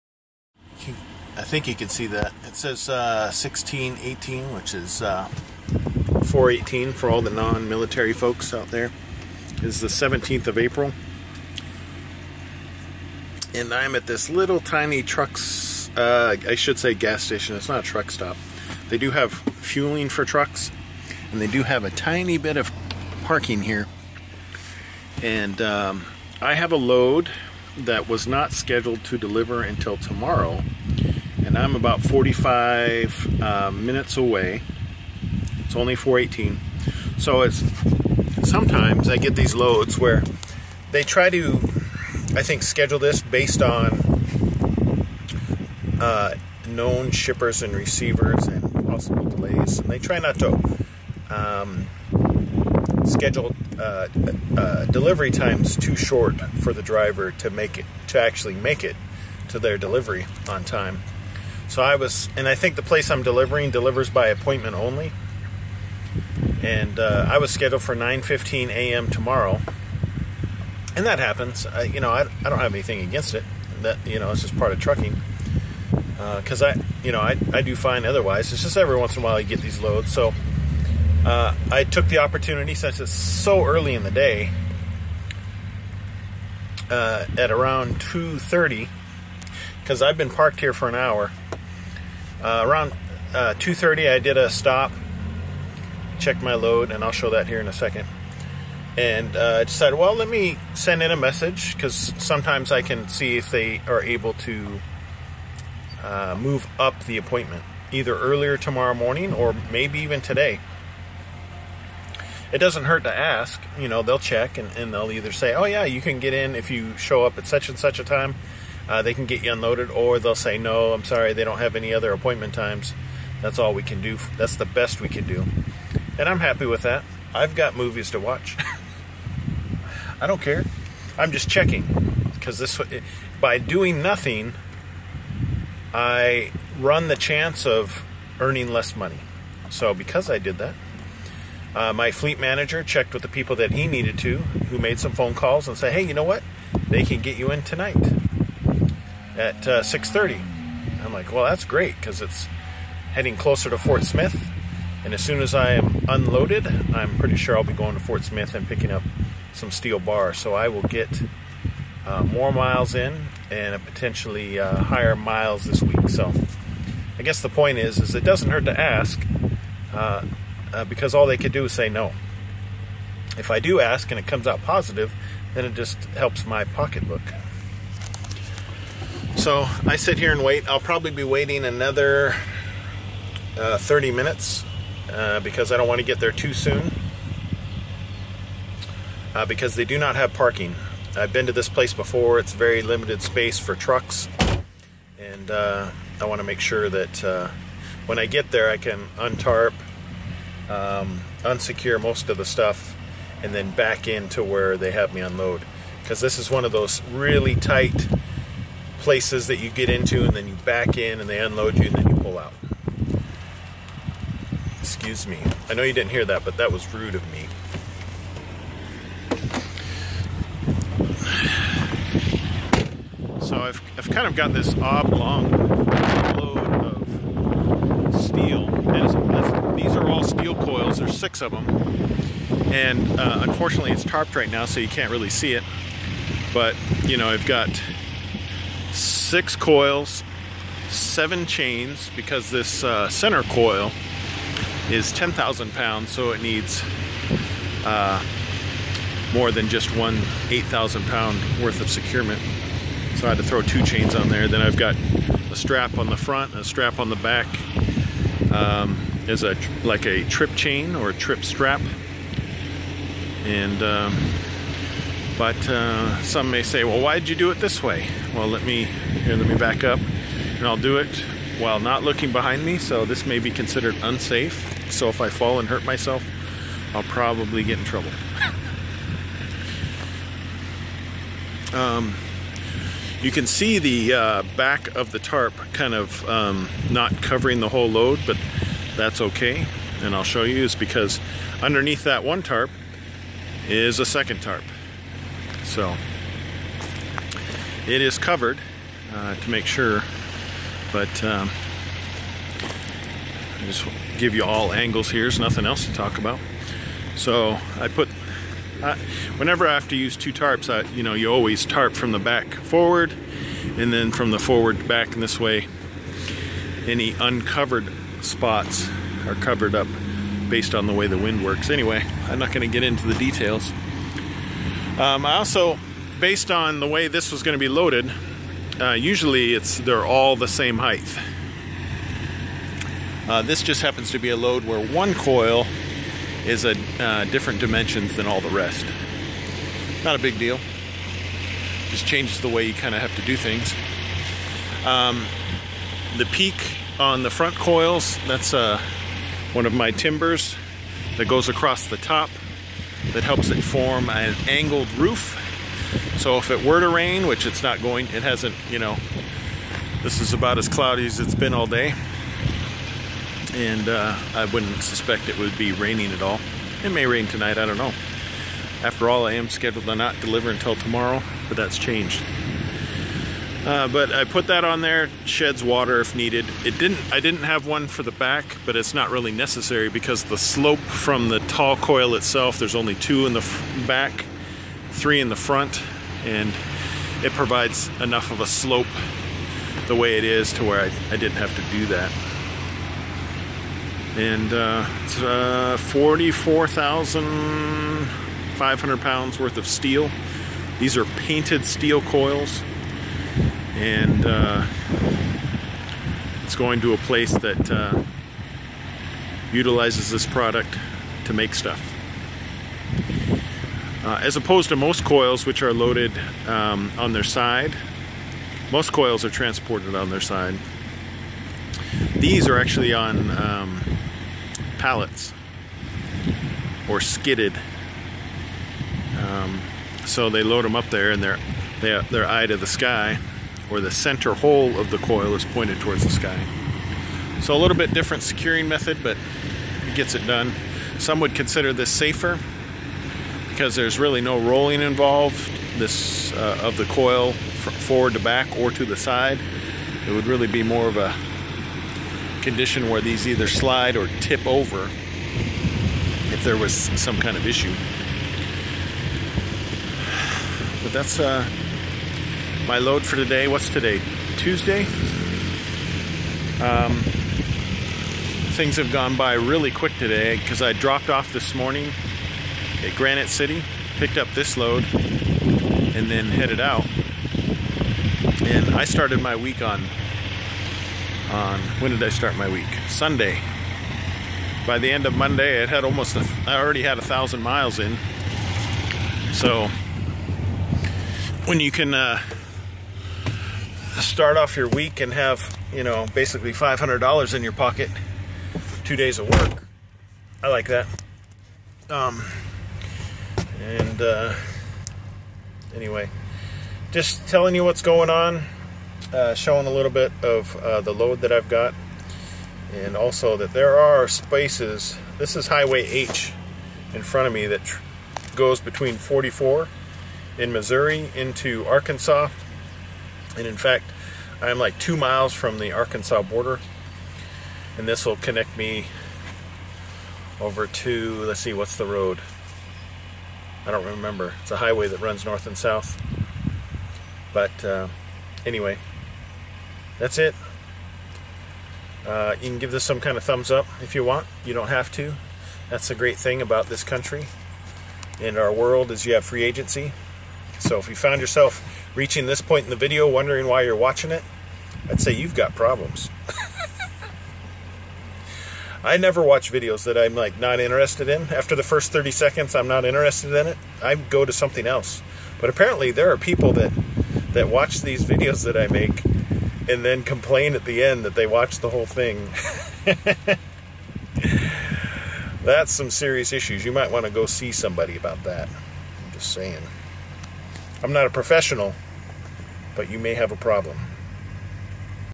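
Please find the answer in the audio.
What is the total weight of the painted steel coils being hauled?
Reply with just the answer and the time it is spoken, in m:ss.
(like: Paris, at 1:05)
44,500 pounds, at 6:35.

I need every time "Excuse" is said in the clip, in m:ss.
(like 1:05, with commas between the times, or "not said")
3:34.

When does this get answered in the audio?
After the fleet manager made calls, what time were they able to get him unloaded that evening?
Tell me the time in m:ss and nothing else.
2:29.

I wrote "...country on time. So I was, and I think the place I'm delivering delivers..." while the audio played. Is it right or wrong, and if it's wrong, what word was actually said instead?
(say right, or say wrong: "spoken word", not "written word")
wrong: "delivery", not "country".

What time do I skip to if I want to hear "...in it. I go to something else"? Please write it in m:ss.
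9:23.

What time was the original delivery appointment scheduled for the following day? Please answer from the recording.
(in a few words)
9:15 a.m.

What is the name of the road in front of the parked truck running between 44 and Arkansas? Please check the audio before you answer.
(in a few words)
Highway H.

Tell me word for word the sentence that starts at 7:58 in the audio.
And I started my week on, on when did I start my week?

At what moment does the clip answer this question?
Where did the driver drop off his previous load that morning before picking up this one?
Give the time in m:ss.
7:52.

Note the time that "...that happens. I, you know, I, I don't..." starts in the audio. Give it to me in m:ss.
1:11.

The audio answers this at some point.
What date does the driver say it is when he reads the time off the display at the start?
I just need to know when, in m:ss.
0:09.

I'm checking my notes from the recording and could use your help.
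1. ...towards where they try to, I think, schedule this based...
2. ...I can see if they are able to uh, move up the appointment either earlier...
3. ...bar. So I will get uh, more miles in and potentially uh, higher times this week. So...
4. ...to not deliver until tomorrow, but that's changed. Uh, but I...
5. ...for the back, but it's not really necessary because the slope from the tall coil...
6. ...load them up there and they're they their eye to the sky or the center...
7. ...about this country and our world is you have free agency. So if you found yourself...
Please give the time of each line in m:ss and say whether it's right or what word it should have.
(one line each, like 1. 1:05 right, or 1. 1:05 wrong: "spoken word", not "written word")
1. 0:39 wrong: "loads", not "towards"
2. 1:42 right
3. 2:39 wrong: "miles", not "times"
4. 6:09 right
5. 6:17 right
6. 7:10 right
7. 9:06 right.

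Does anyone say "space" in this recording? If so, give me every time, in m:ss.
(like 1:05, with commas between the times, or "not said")
3:13, 8:34.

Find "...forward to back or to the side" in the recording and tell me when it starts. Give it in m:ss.
7:27.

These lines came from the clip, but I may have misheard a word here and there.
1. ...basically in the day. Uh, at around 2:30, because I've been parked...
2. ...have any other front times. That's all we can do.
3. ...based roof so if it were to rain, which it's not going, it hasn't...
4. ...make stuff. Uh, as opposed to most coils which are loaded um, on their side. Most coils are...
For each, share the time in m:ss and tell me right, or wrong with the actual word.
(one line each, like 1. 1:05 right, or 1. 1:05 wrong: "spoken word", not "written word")
1. 1:23 wrong: "early", not "basically"
2. 2:01 wrong: "appointment", not "front"
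3. 5:54 wrong: "angled", not "based"
4. 6:51 right.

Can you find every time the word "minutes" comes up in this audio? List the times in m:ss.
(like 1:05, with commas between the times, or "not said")
0:33, 3:04.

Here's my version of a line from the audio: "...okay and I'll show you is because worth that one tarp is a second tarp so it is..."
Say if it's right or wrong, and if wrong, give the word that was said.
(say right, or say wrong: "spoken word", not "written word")
wrong: "underneath", not "worth".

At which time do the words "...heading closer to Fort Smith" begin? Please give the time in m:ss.
2:33.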